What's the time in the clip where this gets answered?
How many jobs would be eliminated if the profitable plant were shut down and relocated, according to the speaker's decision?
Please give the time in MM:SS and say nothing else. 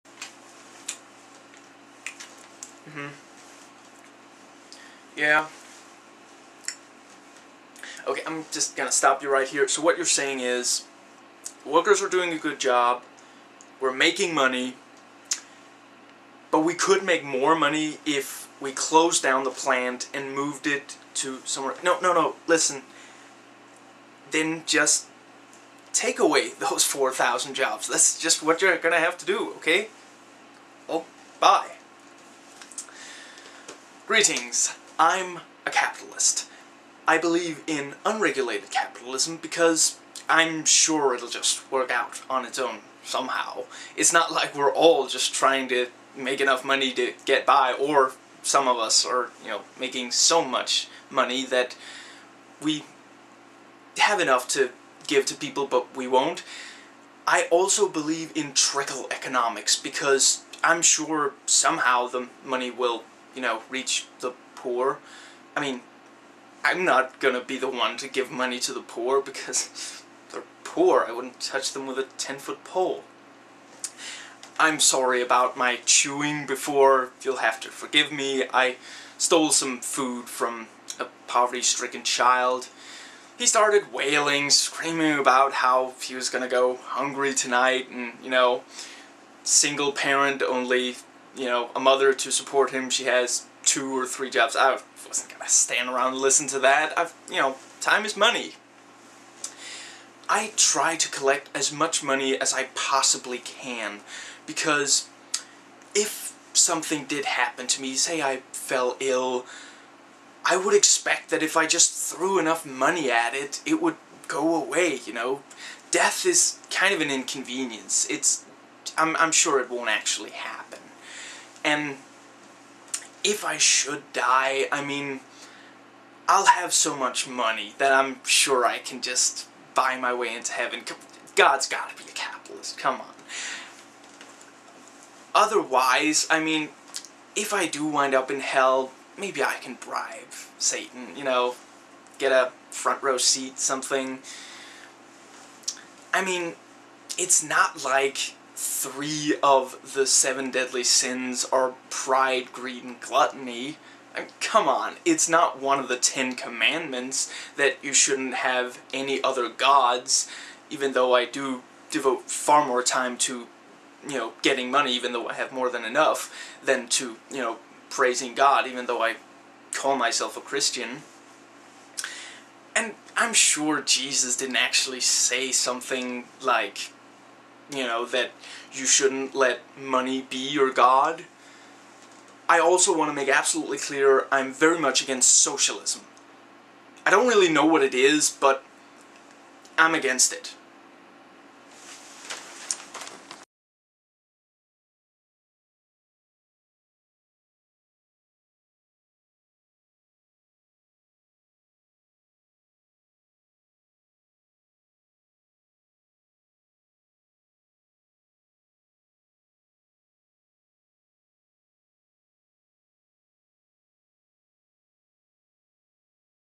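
00:26.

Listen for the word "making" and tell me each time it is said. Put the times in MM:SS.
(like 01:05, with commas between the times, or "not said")
00:13, 00:49.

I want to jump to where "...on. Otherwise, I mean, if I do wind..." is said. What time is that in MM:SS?
02:13.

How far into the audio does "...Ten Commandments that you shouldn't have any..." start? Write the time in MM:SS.
02:35.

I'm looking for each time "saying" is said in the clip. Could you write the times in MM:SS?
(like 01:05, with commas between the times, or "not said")
00:10.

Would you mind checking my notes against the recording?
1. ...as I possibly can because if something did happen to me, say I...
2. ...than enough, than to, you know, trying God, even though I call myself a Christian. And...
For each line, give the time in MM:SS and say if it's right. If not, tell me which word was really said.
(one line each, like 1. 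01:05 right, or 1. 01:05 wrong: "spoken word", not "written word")
1. 01:42 right
2. 02:45 wrong: "praising", not "trying".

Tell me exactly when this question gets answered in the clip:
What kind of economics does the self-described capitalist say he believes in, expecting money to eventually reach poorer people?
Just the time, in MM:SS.
00:58.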